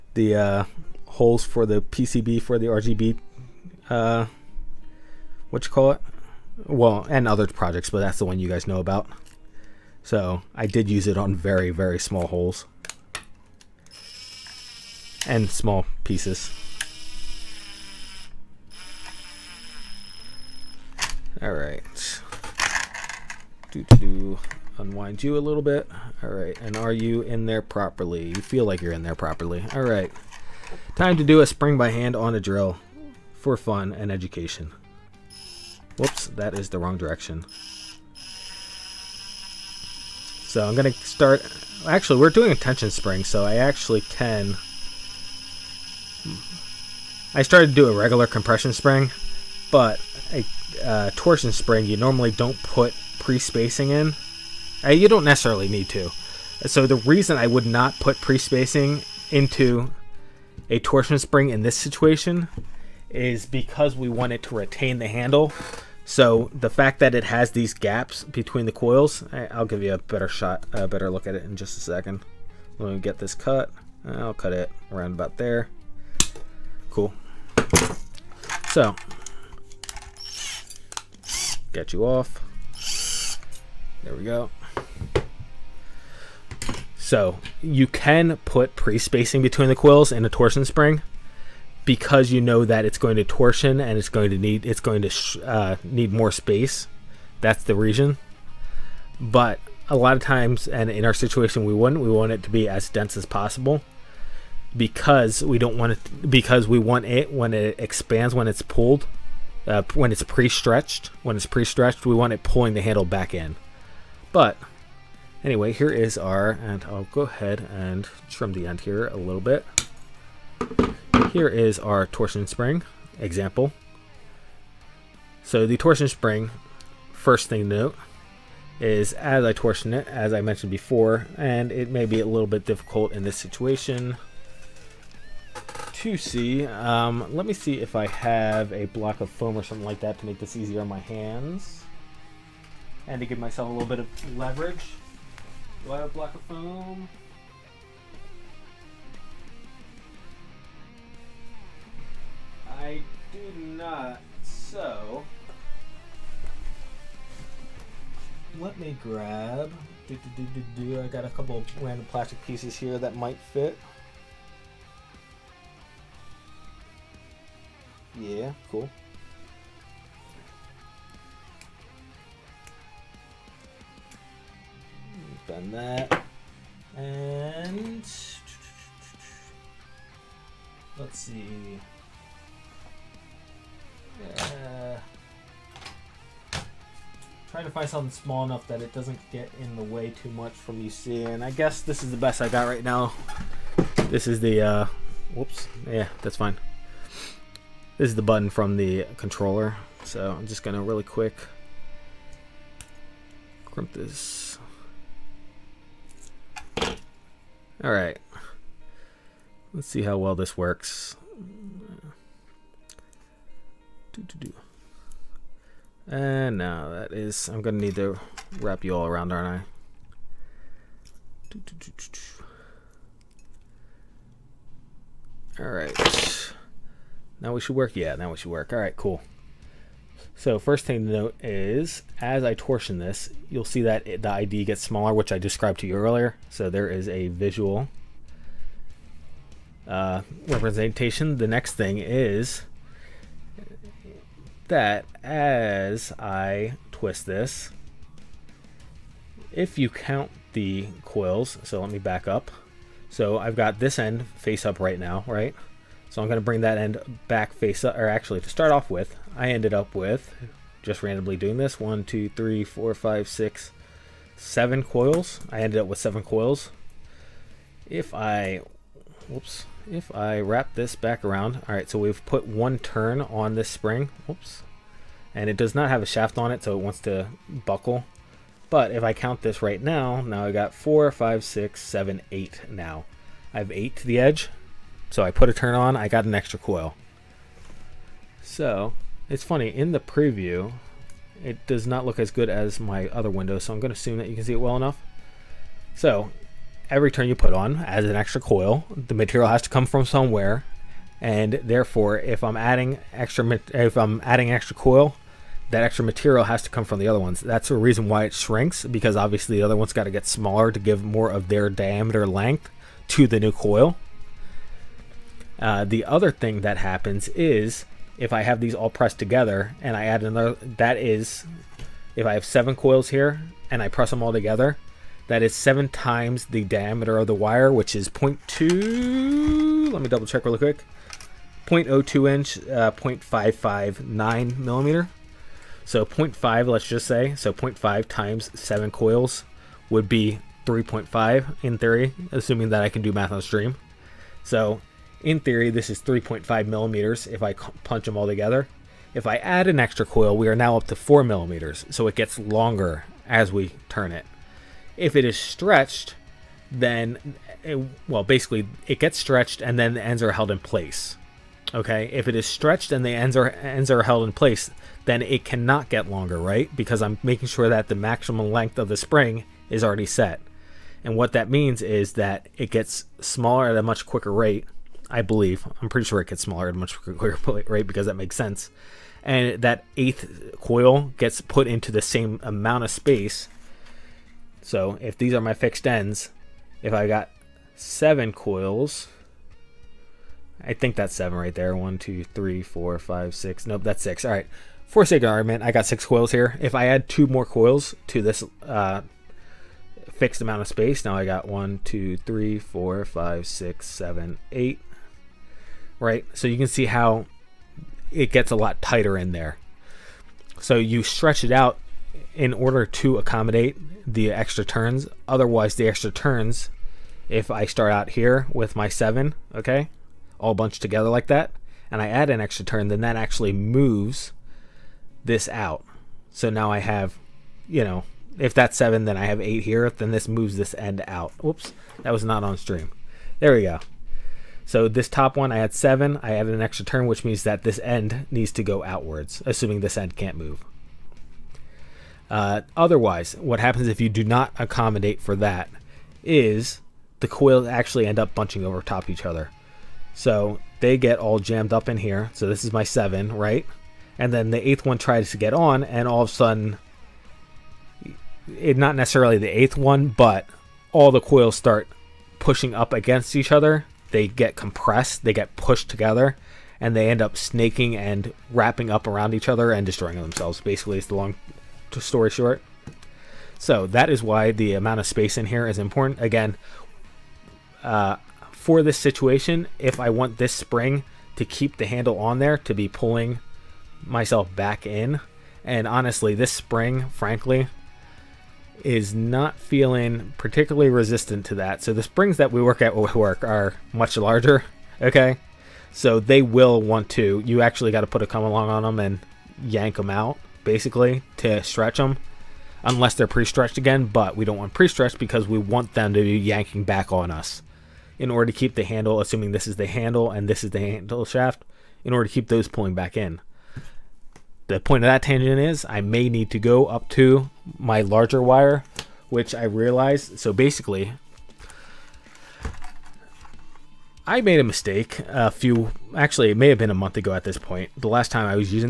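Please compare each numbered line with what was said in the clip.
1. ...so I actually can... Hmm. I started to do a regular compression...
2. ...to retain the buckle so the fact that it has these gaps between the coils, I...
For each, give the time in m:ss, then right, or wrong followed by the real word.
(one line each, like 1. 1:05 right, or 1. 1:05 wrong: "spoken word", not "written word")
1. 0:43 right
2. 1:04 wrong: "handle", not "buckle".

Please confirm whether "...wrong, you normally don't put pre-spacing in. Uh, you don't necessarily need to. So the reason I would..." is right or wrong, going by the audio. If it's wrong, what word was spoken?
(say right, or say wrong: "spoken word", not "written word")
wrong: "spring", not "wrong".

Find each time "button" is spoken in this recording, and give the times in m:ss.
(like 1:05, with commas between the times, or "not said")
3:18.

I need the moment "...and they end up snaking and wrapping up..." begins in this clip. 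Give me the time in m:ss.
7:46.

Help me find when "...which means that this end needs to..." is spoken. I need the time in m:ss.
7:17.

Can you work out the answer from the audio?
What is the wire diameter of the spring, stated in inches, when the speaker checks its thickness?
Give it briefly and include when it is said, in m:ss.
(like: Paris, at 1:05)
0.02 inch, at 5:31.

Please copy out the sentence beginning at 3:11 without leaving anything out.
I guess this is the best I got right now.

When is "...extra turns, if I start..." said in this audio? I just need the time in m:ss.
6:55.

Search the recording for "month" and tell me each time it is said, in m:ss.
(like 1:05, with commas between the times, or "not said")
8:46.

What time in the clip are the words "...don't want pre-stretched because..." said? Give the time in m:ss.
8:24.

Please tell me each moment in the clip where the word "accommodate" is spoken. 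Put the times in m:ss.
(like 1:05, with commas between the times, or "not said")
6:53, 7:24.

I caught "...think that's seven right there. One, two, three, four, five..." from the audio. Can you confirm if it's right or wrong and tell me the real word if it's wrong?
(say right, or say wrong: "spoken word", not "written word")
right.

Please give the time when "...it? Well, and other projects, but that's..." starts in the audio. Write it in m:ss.
0:05.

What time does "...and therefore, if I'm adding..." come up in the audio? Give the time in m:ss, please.
5:01.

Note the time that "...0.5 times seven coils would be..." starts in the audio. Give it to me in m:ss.
5:37.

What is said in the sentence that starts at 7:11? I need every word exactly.
Whoops, that was not on stream.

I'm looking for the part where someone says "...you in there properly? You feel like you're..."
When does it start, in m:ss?
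0:26.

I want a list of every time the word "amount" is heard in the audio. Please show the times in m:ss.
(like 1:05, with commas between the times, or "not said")
6:22, 6:40, 7:54.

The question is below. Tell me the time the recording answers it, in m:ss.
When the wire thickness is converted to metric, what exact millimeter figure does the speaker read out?
5:32.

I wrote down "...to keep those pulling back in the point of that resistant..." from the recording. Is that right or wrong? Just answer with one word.
wrong.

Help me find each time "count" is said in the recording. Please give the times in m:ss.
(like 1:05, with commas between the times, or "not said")
4:09, 4:39.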